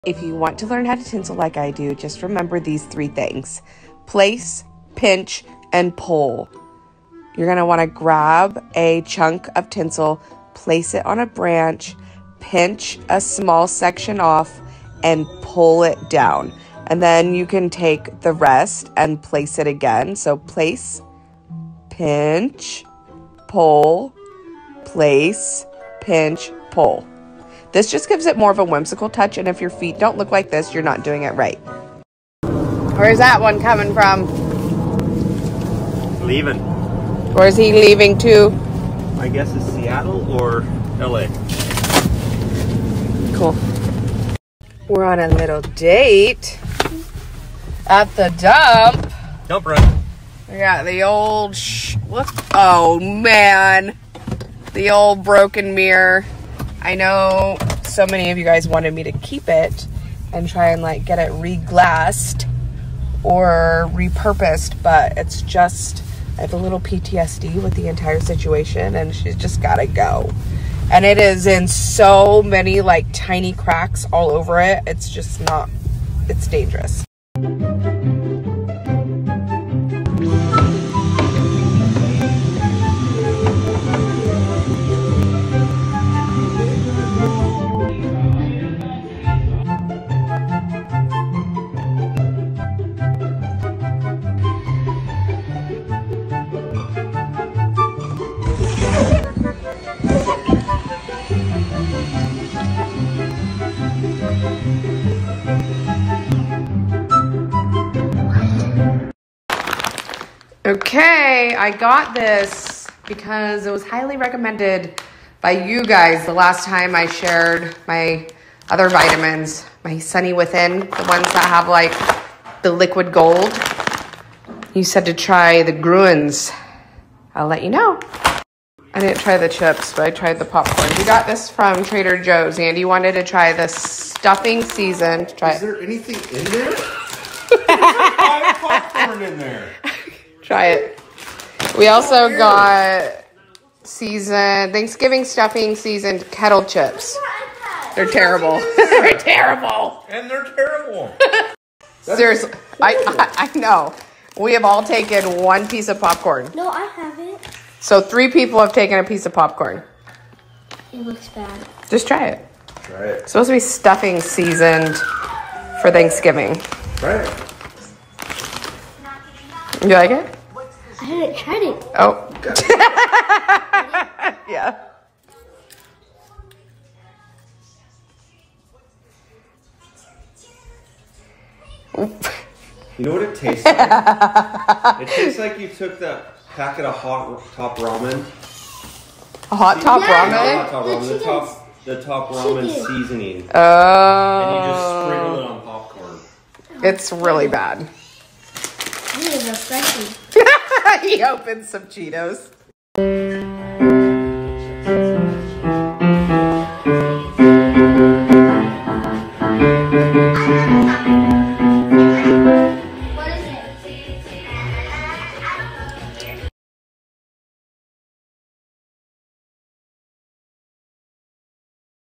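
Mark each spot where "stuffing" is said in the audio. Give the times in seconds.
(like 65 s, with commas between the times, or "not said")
133 s, 145 s, 163 s.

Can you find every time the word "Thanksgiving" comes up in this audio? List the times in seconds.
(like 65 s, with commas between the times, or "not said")
144 s, 165 s.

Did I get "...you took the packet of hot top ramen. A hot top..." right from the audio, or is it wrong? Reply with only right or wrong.
right.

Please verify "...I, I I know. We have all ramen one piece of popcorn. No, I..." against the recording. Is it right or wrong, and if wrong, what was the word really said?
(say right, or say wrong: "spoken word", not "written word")
wrong: "taken", not "ramen".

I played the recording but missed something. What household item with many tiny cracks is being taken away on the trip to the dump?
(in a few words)
broken mirror.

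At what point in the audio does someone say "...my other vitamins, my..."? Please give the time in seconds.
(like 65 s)
117 s.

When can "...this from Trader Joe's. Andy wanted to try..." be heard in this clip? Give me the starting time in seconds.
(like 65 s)
131 s.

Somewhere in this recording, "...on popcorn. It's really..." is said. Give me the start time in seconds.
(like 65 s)
195 s.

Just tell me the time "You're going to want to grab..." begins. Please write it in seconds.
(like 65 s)
7 s.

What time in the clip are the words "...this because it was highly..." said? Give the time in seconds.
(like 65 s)
112 s.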